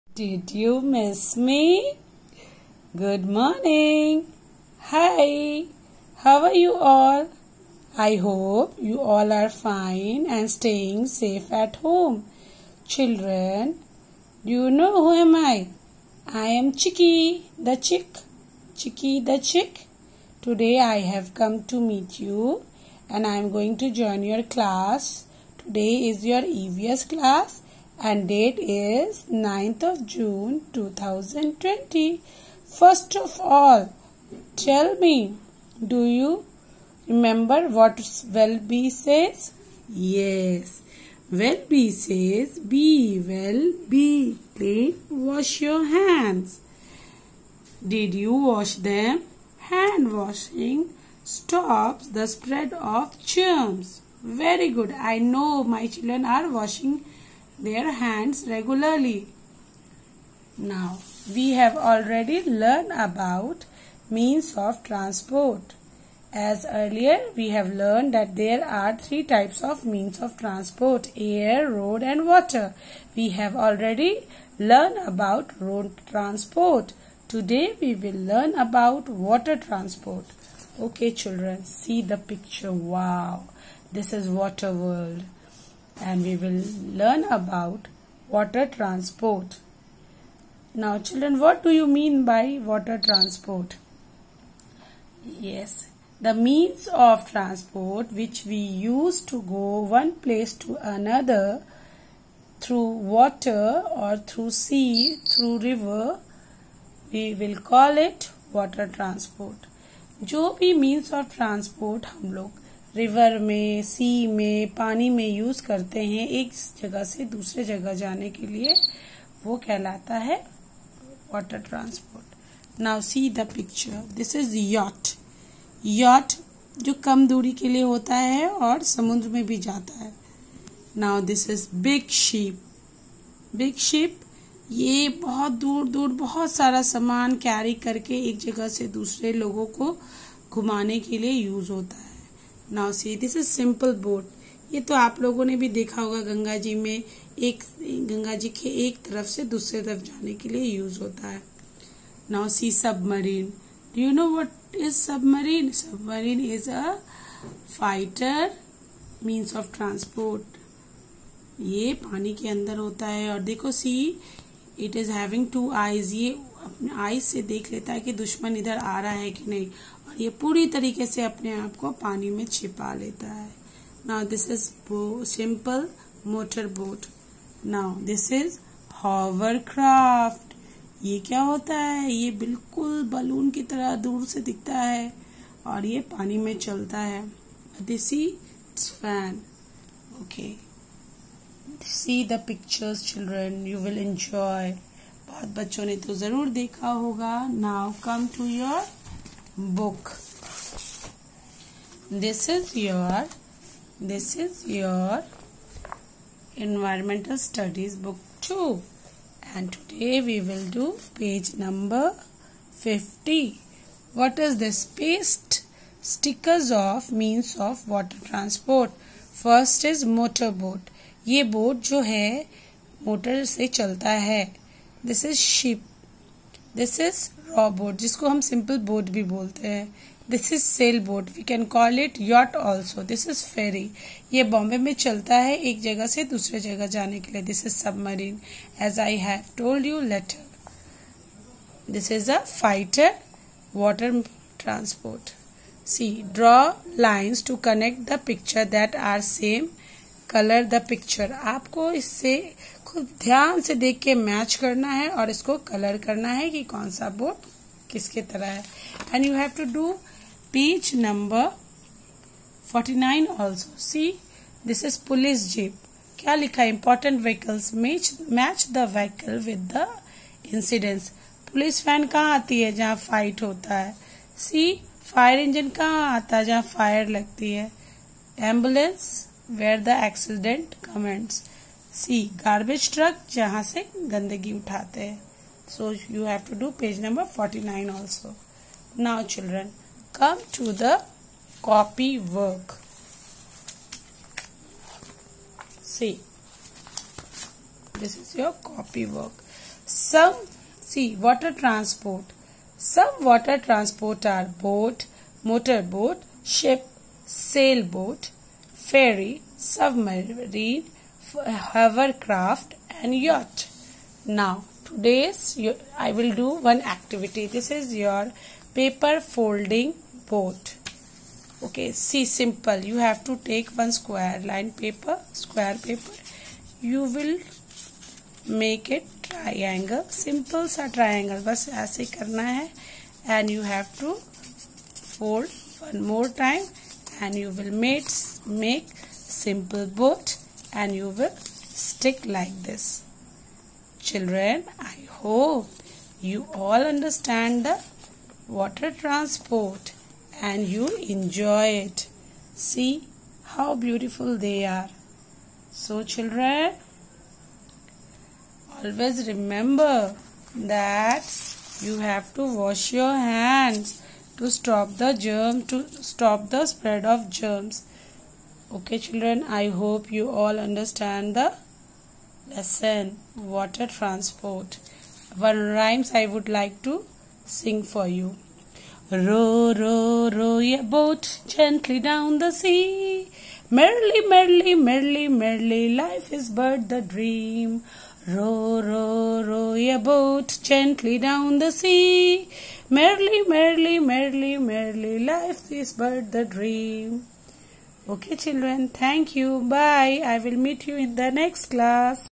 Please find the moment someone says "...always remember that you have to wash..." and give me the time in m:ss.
5:58.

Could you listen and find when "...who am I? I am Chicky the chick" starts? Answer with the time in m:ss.
0:14.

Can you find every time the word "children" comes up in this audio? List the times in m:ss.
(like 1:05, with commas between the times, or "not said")
0:12, 0:55, 1:21, 1:30, 5:43, 5:56, 6:09, 6:38.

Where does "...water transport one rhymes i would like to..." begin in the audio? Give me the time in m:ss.
6:13.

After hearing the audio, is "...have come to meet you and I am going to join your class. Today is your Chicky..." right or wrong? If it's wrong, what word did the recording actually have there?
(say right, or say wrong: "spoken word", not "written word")
wrong: "EVS", not "Chicky".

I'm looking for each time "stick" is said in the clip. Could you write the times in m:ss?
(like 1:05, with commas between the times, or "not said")
5:41.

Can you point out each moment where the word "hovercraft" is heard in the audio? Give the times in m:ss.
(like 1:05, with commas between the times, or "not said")
5:11.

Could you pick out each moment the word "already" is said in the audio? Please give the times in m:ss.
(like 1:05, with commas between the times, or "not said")
1:01, 1:13.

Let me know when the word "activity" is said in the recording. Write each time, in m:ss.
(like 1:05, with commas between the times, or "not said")
5:16.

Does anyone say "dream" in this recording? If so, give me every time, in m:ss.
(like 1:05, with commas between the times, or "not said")
6:27, 6:36.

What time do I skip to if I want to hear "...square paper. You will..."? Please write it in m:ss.
5:25.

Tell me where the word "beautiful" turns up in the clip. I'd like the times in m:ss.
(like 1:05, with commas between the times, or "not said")
5:53.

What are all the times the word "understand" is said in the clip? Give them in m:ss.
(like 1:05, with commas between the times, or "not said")
5:46, 6:10.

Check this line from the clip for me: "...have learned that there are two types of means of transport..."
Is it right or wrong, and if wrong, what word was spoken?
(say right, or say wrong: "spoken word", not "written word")
wrong: "three", not "two".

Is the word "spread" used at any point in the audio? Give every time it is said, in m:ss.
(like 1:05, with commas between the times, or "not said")
0:52, 6:06.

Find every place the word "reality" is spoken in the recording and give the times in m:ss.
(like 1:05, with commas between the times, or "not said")
not said.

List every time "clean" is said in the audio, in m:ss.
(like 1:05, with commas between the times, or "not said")
0:44.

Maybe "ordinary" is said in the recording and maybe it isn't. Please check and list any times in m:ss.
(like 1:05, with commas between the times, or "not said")
not said.